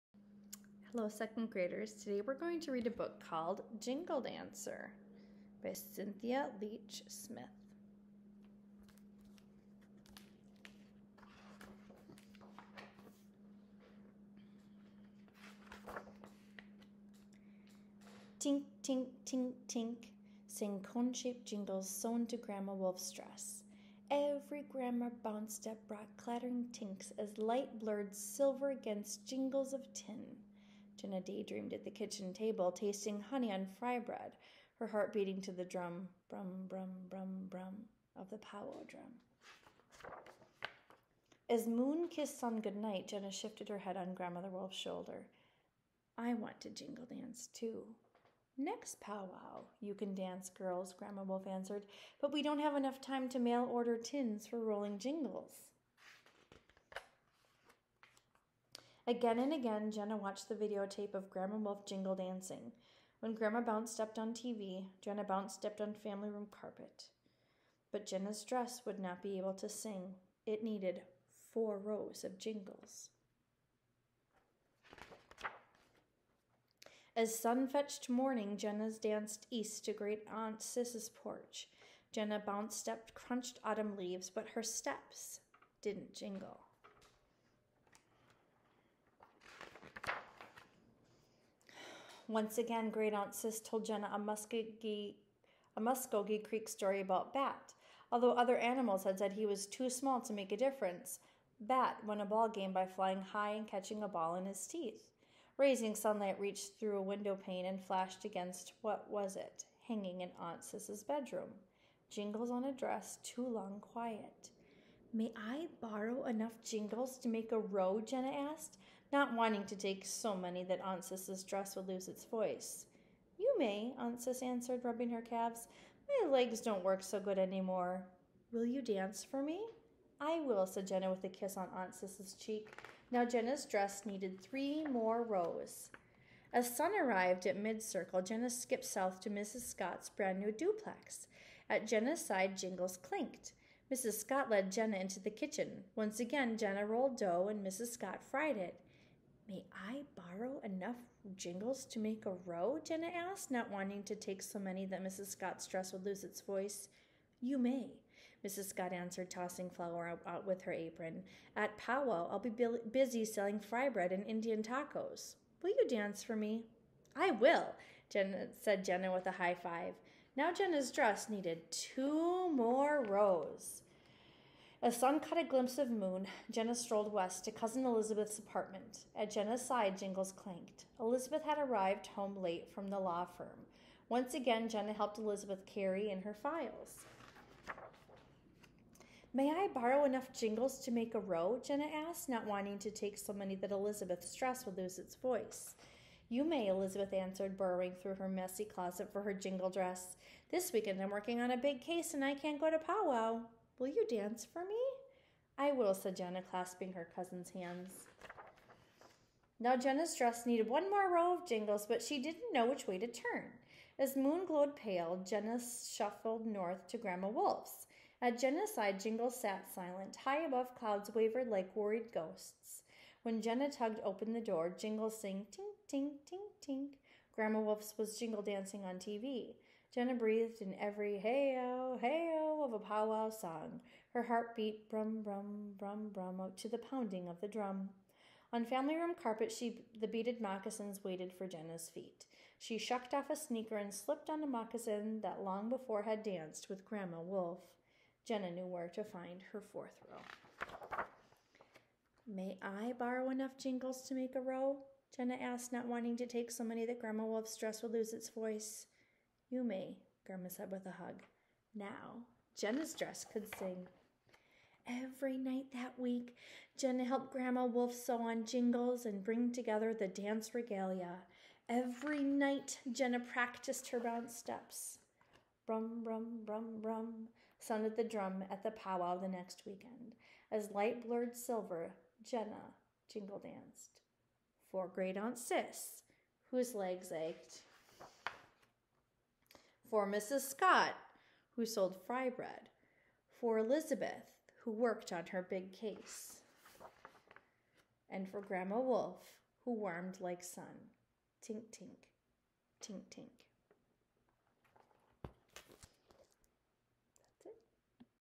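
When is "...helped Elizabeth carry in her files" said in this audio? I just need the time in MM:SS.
03:04.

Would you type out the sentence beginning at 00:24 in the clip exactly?
Every grammar bounce step brought clattering tinks as light blurred silver against jingles of tin.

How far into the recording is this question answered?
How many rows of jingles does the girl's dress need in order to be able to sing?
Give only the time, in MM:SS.
01:11.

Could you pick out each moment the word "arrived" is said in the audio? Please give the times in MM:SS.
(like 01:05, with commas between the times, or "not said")
02:17, 03:01.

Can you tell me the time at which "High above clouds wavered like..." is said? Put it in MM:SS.
03:40.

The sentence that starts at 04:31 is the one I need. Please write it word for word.
Every night, Jenna practiced her bounce steps.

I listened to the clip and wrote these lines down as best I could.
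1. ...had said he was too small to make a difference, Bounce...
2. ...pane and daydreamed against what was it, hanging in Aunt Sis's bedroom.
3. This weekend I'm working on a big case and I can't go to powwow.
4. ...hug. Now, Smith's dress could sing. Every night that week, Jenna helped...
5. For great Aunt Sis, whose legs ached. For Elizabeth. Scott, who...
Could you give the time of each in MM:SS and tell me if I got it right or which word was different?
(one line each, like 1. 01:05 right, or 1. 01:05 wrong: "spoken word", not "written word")
1. 01:39 wrong: "Bat", not "Bounce"
2. 01:47 wrong: "flashed", not "daydreamed"
3. 03:20 right
4. 04:21 wrong: "Jenna", not "Smith"
5. 04:44 wrong: "Mrs", not "Elizabeth".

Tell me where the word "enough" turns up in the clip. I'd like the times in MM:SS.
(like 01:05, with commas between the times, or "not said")
00:52, 01:56, 02:30, 03:10, 04:13.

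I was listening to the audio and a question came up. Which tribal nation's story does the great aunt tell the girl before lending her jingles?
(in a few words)
Muskogee Creek.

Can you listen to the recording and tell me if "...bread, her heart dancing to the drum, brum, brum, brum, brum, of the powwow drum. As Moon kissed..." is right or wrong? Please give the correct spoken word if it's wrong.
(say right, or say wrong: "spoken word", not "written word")
wrong: "beating", not "dancing".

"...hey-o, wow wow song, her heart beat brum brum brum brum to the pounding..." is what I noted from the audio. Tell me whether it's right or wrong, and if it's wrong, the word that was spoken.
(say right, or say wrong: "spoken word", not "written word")
right.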